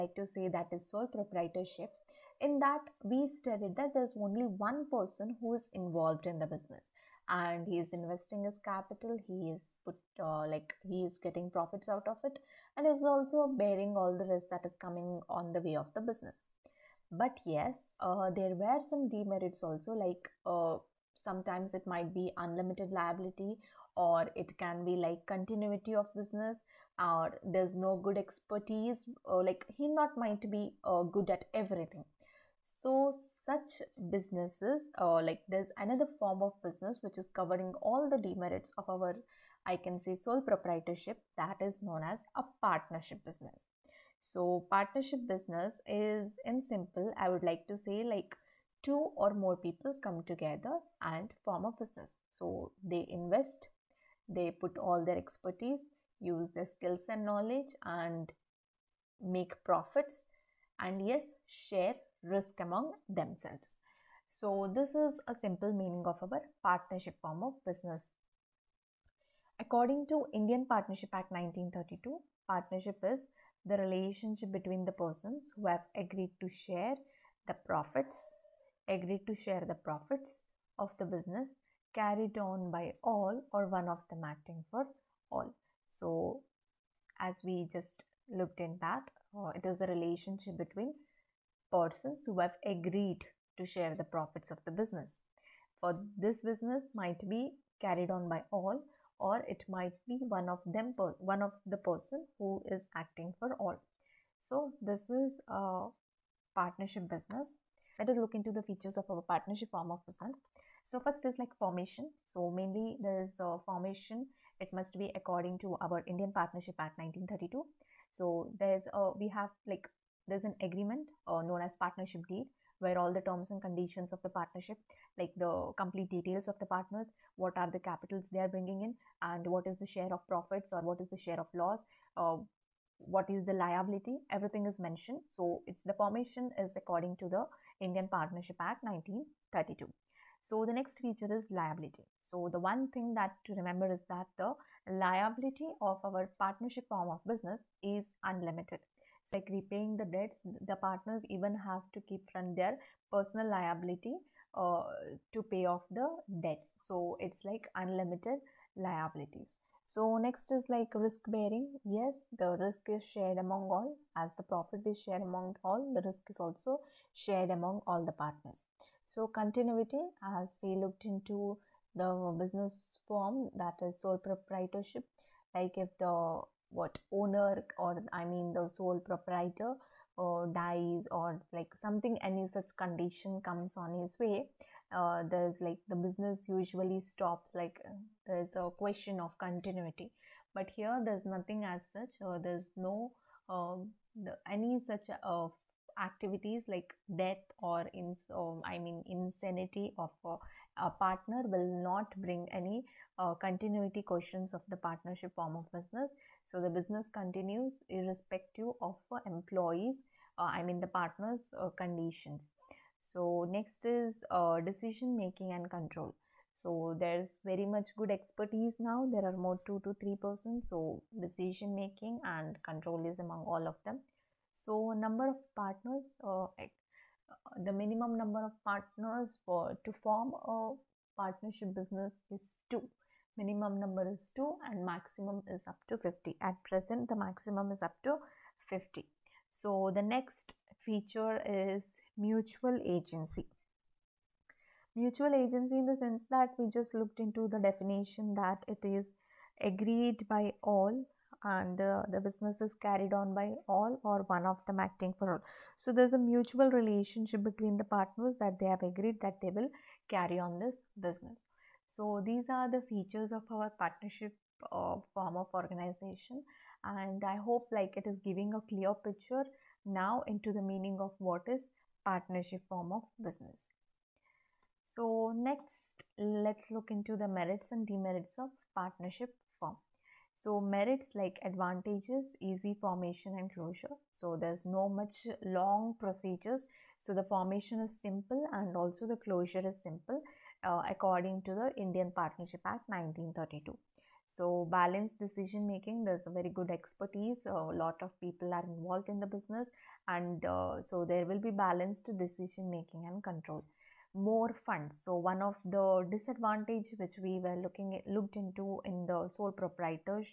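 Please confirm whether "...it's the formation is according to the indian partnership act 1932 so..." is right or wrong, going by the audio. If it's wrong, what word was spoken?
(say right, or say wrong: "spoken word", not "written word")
right.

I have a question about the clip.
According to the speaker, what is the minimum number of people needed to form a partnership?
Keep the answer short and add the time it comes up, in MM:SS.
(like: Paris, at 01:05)
2, at 03:53.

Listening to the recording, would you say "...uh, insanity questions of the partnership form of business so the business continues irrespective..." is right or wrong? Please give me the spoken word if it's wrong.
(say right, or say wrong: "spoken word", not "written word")
wrong: "continuity", not "insanity".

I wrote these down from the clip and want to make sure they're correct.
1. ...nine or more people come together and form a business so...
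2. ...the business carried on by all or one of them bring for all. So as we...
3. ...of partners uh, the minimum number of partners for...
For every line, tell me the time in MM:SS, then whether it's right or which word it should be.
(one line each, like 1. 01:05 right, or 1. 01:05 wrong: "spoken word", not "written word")
1. 00:48 wrong: "two", not "nine"
2. 01:20 wrong: "acting", not "bring"
3. 03:45 right.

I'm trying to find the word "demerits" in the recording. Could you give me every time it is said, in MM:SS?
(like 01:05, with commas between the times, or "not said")
00:19, 00:38, 04:37.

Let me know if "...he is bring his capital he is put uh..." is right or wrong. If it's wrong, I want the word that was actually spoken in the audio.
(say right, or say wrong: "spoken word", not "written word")
wrong: "investing", not "bring".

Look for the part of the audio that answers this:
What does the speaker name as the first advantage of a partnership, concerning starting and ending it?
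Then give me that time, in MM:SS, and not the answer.
04:42.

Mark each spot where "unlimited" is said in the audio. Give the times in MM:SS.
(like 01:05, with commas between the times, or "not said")
00:22, 02:28, 02:37.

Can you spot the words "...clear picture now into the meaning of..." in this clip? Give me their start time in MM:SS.
04:28.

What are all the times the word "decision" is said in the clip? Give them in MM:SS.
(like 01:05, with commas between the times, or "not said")
03:34, 03:41, 04:55, 05:02.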